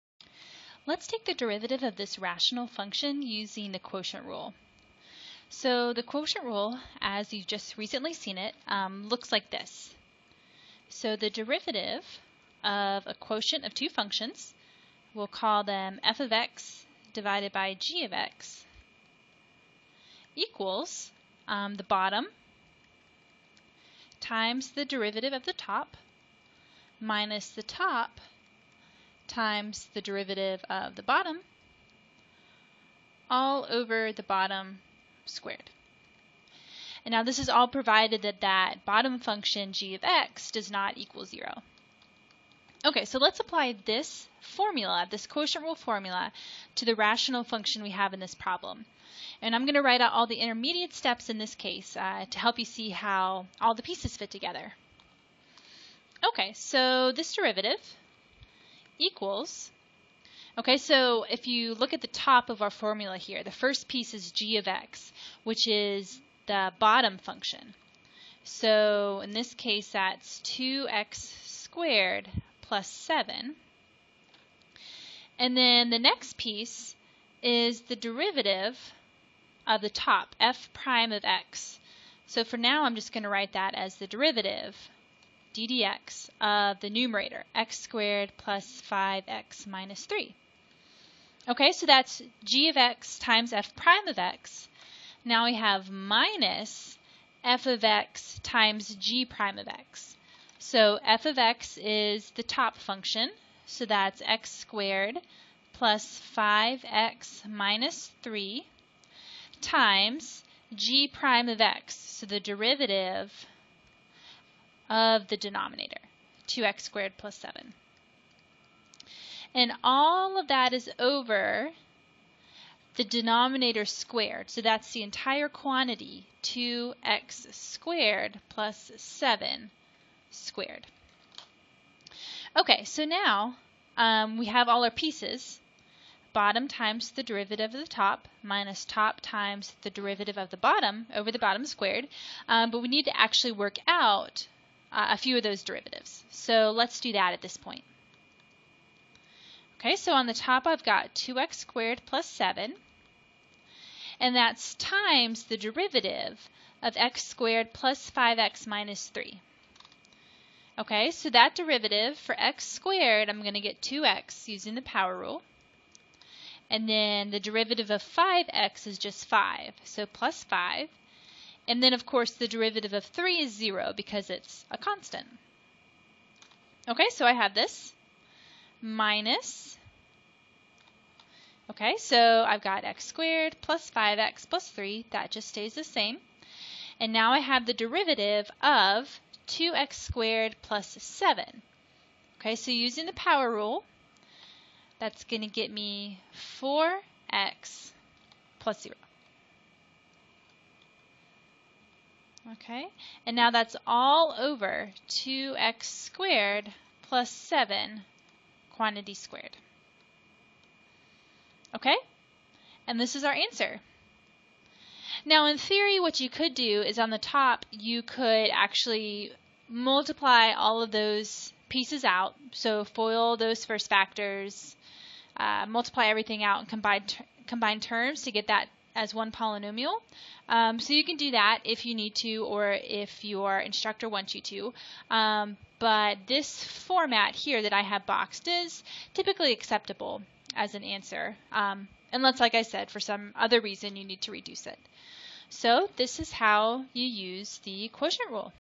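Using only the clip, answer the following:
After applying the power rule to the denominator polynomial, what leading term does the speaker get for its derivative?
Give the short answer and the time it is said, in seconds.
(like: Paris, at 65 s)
4x, at 196 s.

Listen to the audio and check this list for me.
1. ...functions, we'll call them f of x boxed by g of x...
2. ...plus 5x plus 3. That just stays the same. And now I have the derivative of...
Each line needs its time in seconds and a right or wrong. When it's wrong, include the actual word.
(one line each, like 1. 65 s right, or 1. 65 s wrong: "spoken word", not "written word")
1. 13 s wrong: "divided", not "boxed"
2. 183 s right.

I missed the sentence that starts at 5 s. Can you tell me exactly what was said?
So the quotient rule, as you've just recently seen it, um, looks like this.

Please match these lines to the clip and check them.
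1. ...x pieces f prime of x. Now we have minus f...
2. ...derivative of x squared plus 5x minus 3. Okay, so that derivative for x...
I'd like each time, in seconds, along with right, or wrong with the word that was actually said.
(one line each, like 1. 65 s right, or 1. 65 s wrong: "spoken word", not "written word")
1. 92 s wrong: "times", not "pieces"
2. 155 s right.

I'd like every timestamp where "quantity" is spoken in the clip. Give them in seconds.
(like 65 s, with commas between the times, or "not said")
125 s, 208 s.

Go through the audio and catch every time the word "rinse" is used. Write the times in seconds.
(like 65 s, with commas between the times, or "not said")
not said.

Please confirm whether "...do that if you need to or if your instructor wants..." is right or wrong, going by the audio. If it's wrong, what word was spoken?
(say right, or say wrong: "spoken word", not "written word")
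right.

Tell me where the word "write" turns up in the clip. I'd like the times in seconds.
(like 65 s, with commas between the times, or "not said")
49 s, 83 s.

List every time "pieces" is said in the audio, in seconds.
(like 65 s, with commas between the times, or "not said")
53 s, 63 s, 76 s, 134 s, 221 s.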